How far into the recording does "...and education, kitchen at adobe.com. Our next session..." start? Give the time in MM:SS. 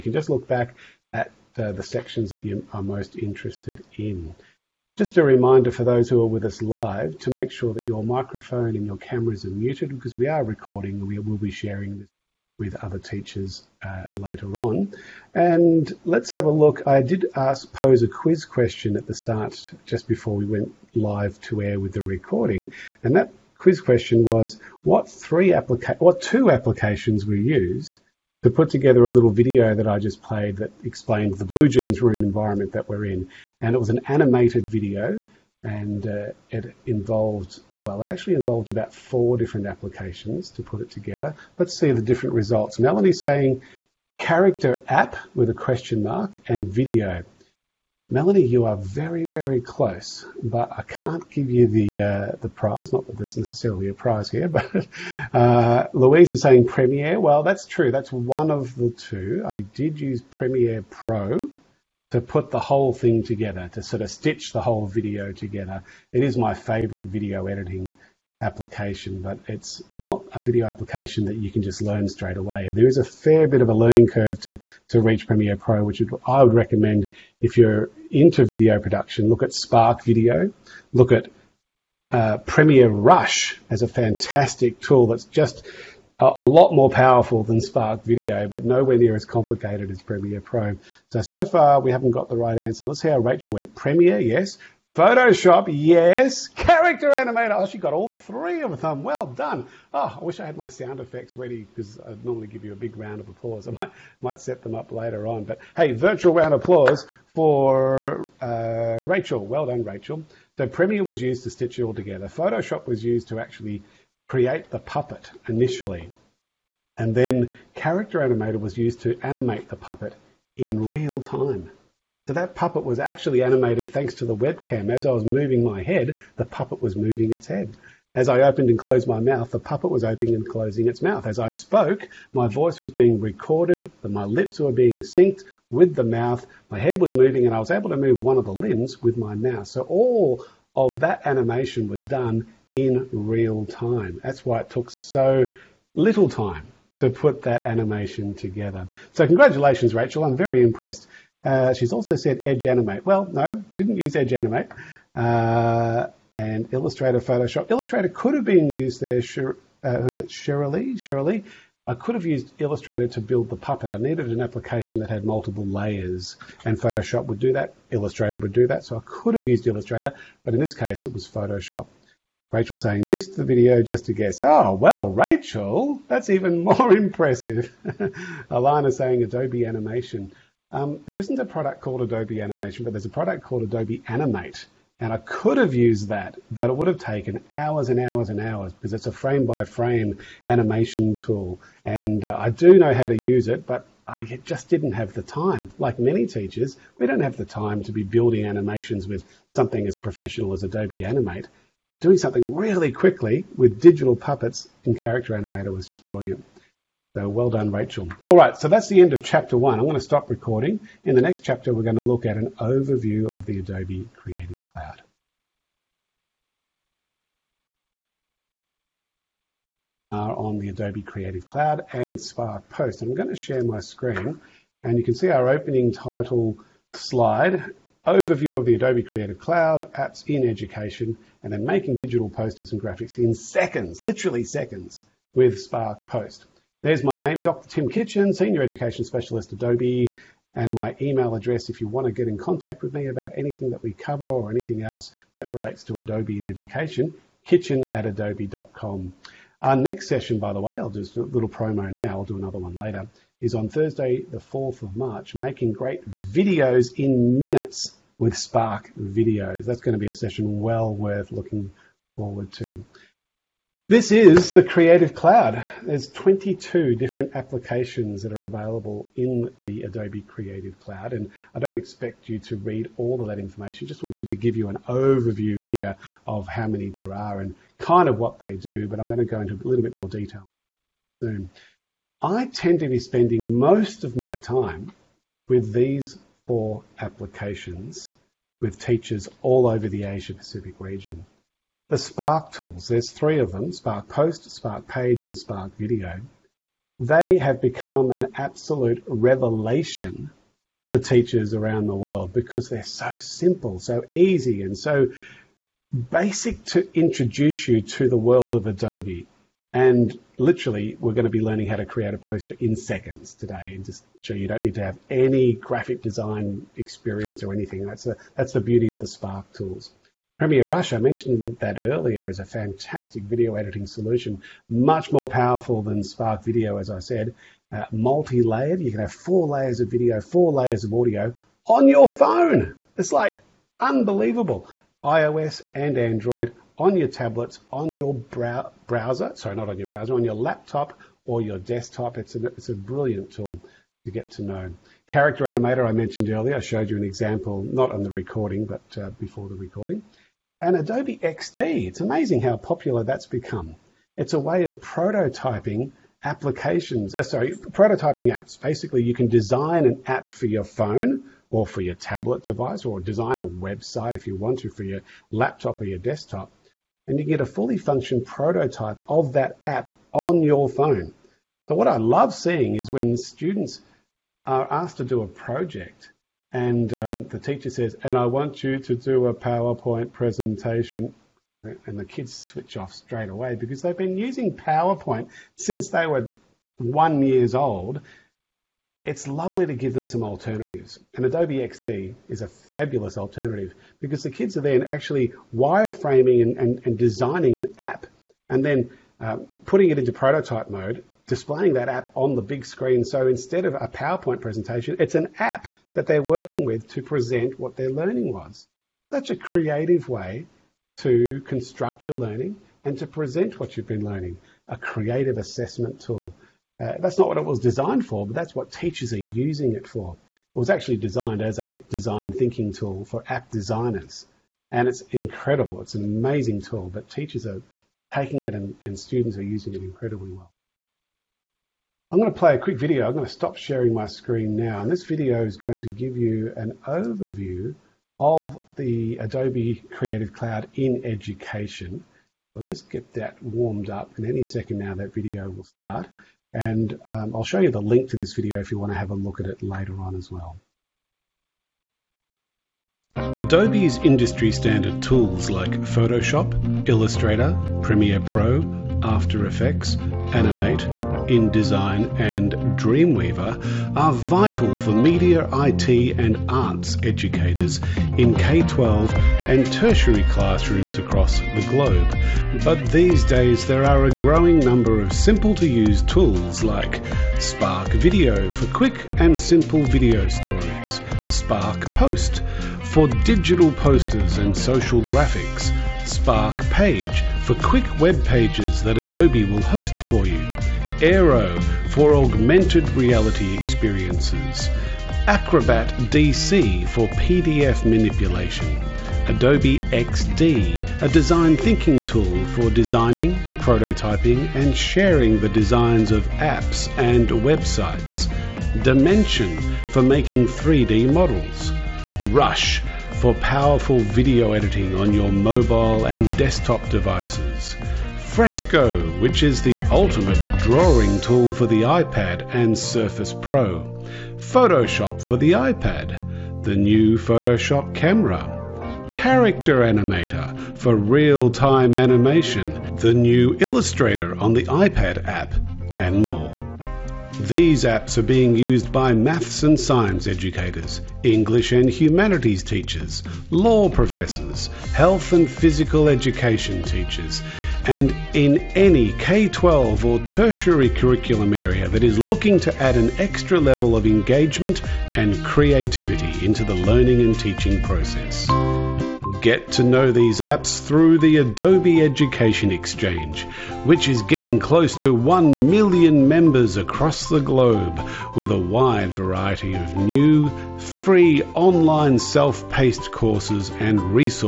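04:06.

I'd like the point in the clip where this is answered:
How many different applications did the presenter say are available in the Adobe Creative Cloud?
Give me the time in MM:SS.
04:26.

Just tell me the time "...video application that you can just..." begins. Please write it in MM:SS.
01:10.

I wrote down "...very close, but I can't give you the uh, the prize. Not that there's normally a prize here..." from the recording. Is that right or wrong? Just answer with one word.
wrong.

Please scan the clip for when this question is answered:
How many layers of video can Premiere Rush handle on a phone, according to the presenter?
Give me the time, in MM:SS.
05:29.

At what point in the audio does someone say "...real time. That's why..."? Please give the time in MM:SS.
02:23.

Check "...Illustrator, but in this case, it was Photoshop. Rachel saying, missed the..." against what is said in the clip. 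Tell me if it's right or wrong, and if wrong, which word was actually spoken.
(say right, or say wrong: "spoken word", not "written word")
right.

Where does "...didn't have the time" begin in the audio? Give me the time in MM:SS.
03:14.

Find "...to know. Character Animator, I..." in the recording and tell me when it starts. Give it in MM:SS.
05:44.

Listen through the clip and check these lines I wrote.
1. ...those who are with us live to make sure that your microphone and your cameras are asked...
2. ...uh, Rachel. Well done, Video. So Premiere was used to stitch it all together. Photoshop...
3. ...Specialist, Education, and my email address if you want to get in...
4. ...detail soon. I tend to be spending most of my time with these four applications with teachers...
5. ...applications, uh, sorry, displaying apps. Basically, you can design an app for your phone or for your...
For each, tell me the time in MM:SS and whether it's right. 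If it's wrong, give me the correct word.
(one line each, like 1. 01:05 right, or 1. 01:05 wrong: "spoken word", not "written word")
1. 00:05 wrong: "muted", not "asked"
2. 01:48 wrong: "Rachel", not "Video"
3. 03:59 wrong: "Adobe", not "Education"
4. 04:40 right
5. 05:56 wrong: "prototyping", not "displaying".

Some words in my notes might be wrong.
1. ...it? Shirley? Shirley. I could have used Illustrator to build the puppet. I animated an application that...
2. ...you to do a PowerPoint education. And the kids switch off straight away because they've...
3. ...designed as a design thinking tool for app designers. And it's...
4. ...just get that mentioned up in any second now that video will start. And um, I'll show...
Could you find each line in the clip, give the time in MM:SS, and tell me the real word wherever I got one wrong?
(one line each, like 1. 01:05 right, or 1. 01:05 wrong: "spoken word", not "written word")
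1. 02:40 wrong: "needed", not "animated"
2. 06:18 wrong: "presentation", not "education"
3. 07:00 right
4. 07:22 wrong: "warmed", not "mentioned".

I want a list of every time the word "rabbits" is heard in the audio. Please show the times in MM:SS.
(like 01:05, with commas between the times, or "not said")
not said.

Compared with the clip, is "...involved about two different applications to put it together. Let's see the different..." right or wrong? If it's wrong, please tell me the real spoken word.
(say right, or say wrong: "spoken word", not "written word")
wrong: "four", not "two".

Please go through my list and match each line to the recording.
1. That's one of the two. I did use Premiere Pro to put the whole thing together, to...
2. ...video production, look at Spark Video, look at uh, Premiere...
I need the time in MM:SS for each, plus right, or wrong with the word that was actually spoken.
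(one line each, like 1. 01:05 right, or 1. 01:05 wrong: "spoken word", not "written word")
1. 00:57 right
2. 01:18 right.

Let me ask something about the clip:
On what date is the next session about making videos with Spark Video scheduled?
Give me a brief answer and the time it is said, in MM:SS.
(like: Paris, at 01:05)
Thursday, 4 March, at 04:13.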